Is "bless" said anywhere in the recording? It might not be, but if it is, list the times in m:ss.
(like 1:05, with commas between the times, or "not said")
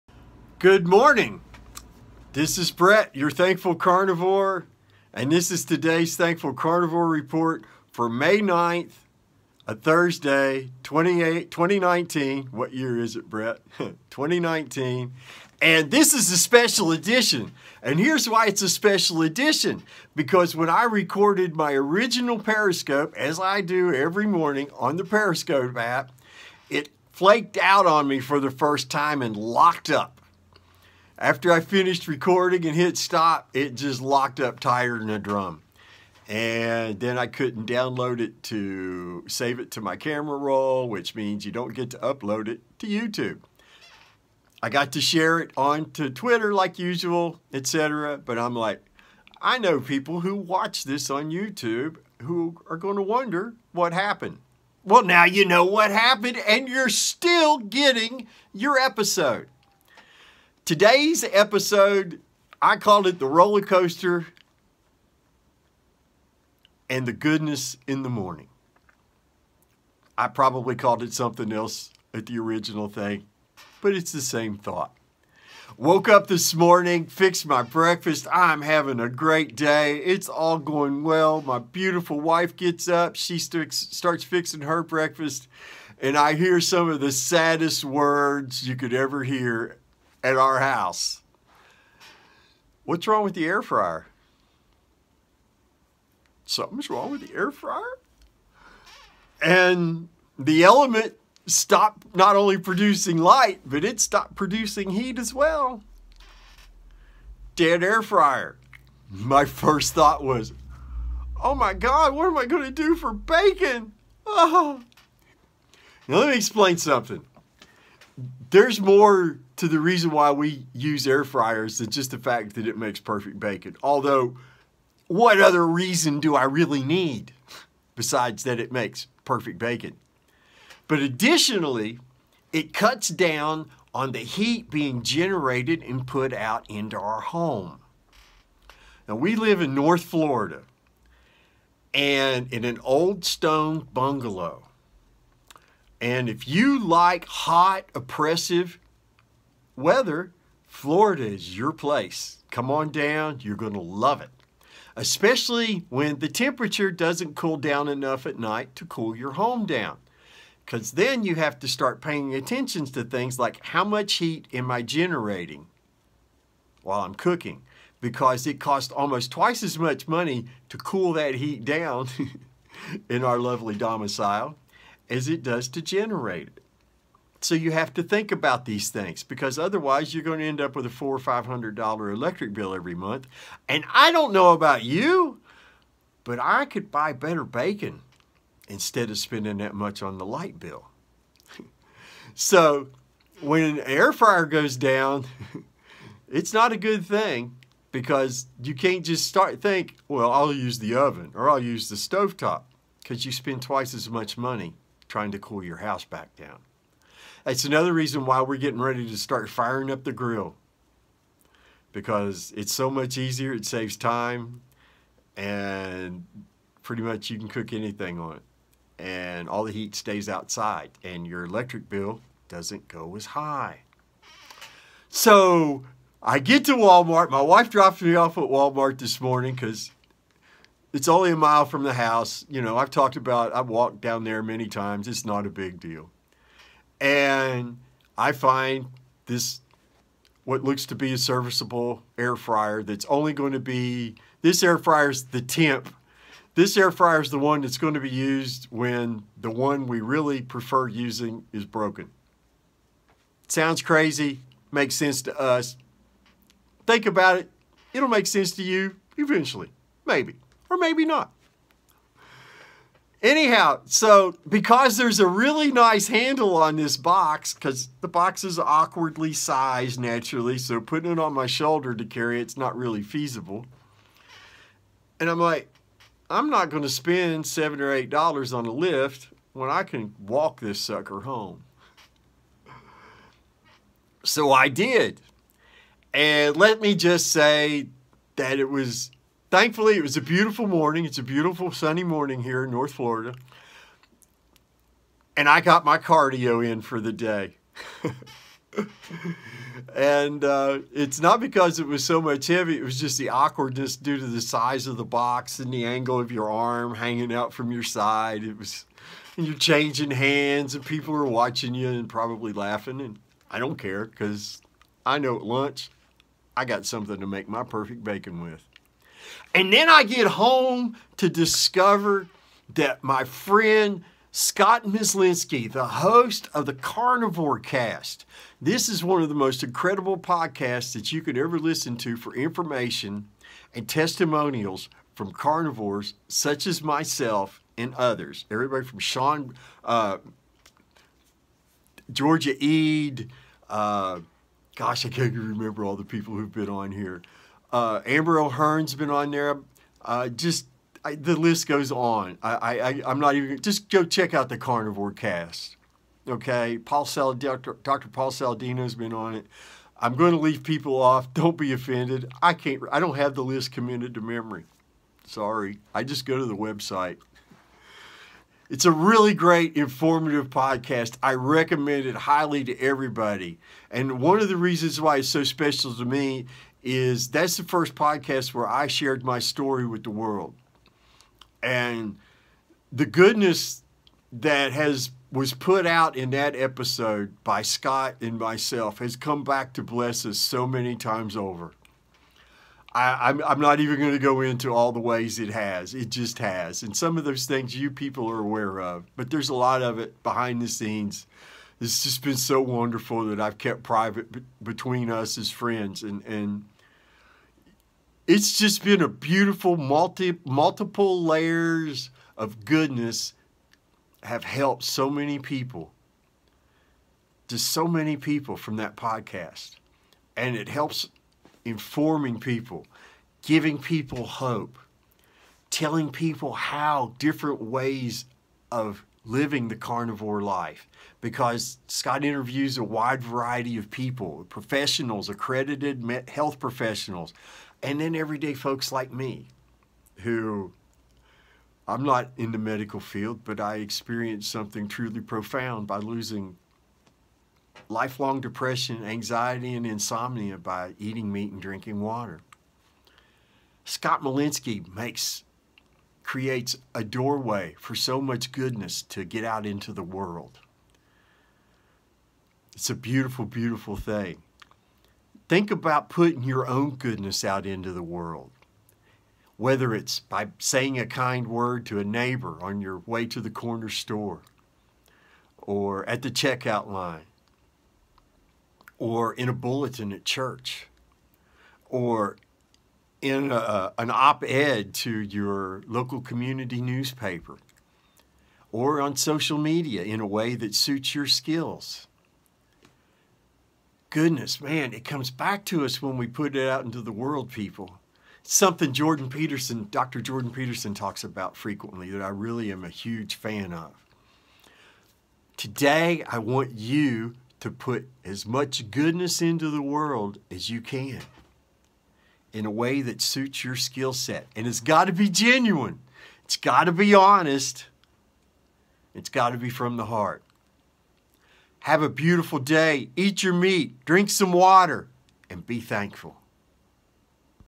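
6:29.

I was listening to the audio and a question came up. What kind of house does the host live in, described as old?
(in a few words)
Stone bungalow.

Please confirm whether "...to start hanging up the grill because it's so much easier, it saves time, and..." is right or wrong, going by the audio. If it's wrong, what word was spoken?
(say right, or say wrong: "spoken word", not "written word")
wrong: "firing", not "hanging".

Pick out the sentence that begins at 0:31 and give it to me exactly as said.
After I finished recording and hit stop, it just locked up tighter than a drum.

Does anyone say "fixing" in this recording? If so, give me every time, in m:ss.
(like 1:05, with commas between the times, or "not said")
1:24.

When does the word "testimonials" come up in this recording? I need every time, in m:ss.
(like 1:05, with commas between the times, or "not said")
5:33.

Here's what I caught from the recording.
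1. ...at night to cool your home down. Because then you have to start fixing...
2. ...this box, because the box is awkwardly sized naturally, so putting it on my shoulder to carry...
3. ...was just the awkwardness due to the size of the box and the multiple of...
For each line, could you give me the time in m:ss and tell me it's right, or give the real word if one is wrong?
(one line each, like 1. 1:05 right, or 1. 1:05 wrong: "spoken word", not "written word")
1. 2:38 wrong: "paying", not "fixing"
2. 4:26 right
3. 5:02 wrong: "angle", not "multiple".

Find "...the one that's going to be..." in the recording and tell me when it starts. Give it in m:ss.
4:07.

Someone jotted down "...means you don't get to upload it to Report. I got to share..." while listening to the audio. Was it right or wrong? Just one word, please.
wrong.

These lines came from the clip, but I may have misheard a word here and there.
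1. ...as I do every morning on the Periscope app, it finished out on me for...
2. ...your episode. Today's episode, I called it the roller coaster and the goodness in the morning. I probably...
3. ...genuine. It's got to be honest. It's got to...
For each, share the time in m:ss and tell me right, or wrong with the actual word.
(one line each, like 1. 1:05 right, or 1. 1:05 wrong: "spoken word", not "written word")
1. 0:23 wrong: "flaked", not "finished"
2. 0:58 right
3. 8:35 right.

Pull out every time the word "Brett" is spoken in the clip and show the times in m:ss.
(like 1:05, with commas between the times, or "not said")
0:02, 0:13.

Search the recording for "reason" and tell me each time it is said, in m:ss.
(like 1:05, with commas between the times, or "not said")
1:59, 2:05, 3:27, 6:14.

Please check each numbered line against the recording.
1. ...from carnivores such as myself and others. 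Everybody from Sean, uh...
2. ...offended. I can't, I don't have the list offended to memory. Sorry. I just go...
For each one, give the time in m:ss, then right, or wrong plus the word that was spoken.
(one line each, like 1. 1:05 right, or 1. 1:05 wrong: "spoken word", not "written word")
1. 5:35 right
2. 6:01 wrong: "committed", not "offended".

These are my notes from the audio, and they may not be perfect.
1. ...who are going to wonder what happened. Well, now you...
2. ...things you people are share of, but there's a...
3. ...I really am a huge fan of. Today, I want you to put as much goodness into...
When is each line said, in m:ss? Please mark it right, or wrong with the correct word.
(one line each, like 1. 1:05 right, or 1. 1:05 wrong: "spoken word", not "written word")
1. 0:52 right
2. 6:37 wrong: "aware", not "share"
3. 8:22 right.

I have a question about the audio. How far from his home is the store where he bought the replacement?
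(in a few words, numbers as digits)
A mile.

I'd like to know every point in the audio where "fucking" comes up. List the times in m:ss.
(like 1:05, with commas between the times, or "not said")
not said.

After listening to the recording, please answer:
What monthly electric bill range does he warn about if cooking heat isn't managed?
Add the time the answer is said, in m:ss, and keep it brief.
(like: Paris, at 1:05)
$400-500, at 3:00.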